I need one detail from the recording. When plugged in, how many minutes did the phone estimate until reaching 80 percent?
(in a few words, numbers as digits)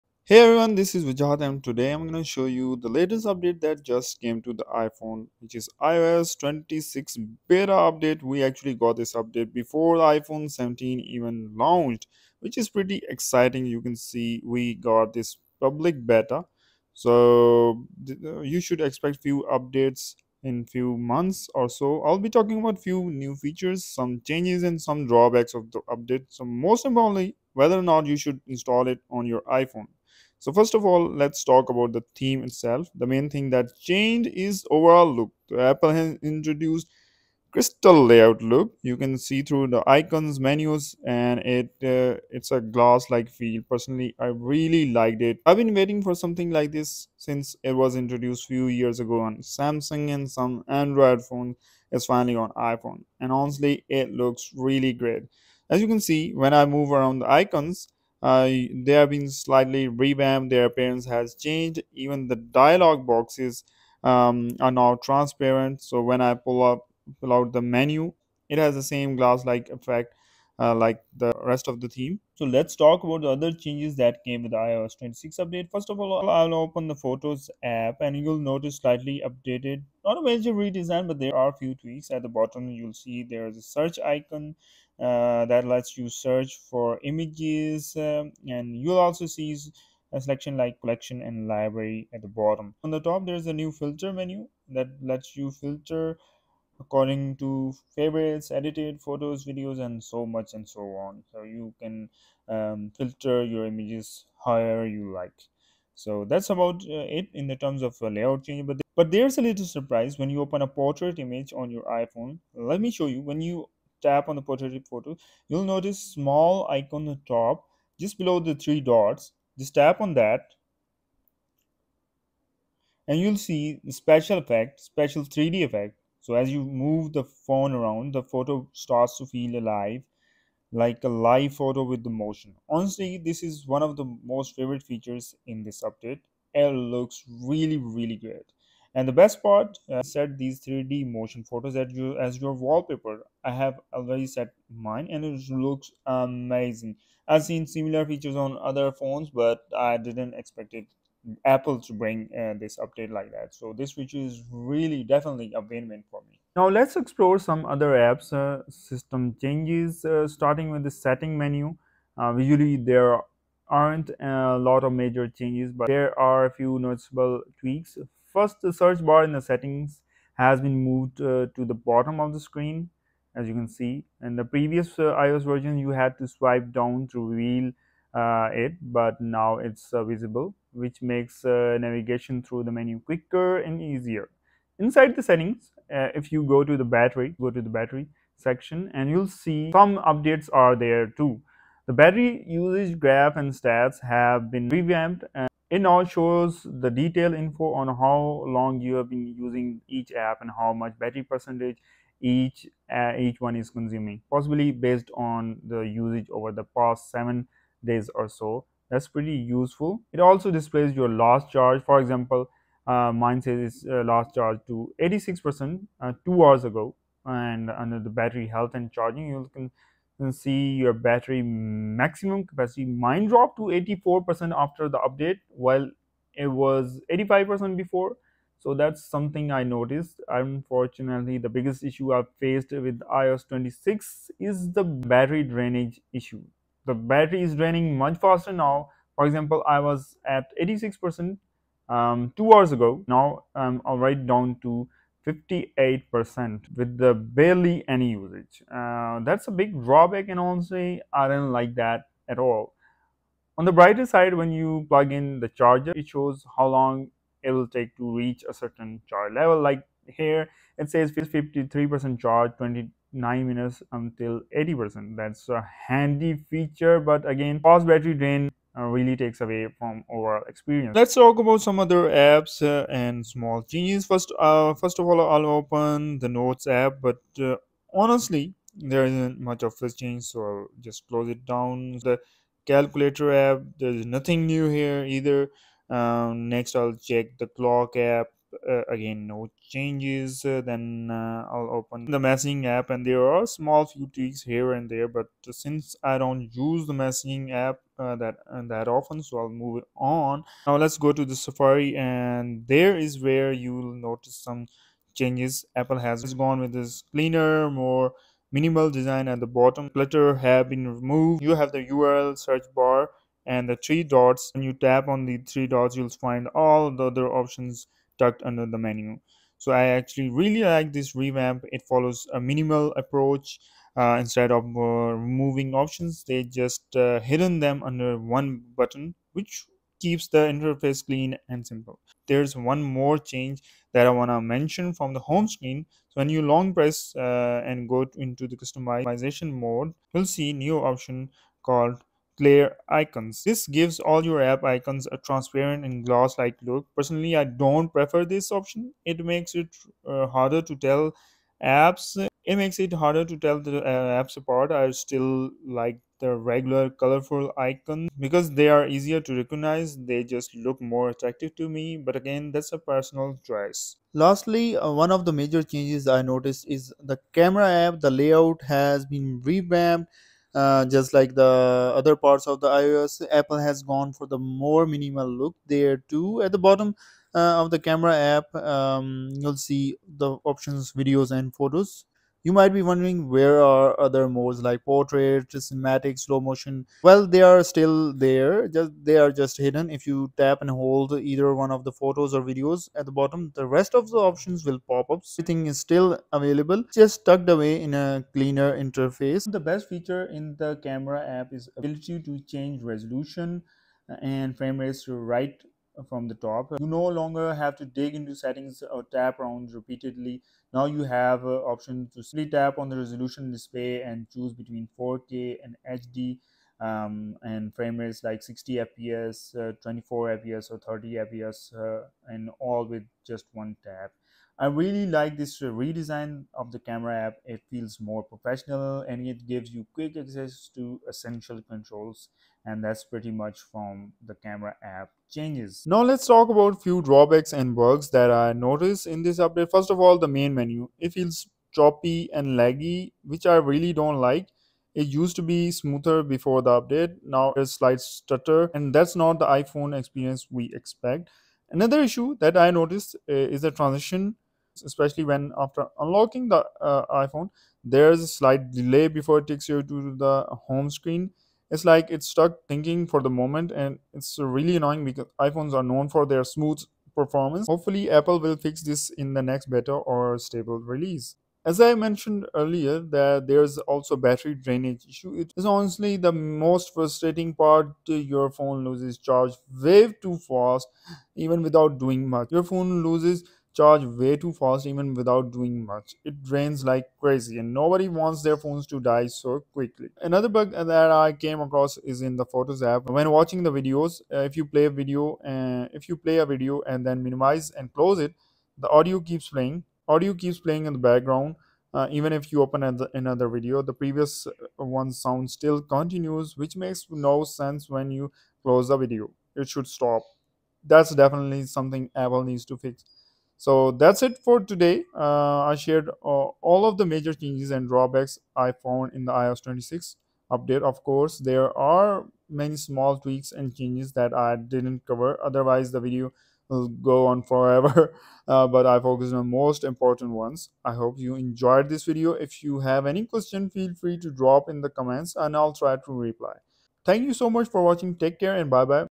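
29.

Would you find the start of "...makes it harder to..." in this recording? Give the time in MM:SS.
05:52.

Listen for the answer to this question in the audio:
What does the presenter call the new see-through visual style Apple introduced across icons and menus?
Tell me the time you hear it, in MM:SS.
00:37.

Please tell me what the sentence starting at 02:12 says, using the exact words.
Honestly, this is one of the most favorite features in this update.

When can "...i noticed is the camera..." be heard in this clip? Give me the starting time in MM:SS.
06:06.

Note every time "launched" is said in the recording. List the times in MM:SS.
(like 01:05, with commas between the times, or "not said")
00:11.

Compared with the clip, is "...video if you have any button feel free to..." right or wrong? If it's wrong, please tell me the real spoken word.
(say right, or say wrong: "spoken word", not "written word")
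wrong: "question", not "button".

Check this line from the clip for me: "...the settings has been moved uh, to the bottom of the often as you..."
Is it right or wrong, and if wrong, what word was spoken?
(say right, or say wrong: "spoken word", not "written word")
wrong: "screen", not "often".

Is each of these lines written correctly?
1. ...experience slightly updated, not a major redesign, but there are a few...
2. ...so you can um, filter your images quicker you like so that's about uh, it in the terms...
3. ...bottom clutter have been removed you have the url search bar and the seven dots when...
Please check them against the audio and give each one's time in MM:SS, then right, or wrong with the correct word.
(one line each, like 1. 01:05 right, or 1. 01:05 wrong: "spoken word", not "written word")
1. 01:18 wrong: "notice", not "experience"
2. 01:41 wrong: "however", not "quicker"
3. 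05:09 wrong: "three", not "seven".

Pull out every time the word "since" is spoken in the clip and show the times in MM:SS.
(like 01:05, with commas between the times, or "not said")
00:47, 04:55.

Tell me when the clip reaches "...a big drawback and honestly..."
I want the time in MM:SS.
04:09.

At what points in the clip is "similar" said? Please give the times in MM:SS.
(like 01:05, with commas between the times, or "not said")
02:27.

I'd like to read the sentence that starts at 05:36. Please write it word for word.
So when you long press uh, and go into the customization mode, you'll see new option called clear icons.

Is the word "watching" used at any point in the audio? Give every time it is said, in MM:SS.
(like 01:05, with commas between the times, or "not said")
08:13, 08:57.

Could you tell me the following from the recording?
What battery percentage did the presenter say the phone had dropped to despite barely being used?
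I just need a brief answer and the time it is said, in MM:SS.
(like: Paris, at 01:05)
58 percent, at 04:05.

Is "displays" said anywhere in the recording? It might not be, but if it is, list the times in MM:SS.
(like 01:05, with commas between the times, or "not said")
03:30, 06:53.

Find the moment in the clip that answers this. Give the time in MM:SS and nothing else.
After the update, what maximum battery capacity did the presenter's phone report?
03:43.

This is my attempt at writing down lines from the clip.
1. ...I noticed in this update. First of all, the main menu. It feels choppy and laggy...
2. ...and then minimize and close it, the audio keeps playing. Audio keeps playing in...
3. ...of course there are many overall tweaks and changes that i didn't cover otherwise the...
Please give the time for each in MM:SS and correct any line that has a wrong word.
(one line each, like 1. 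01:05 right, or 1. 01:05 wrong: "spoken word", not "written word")
1. 07:18 right
2. 08:16 right
3. 08:40 wrong: "small", not "overall".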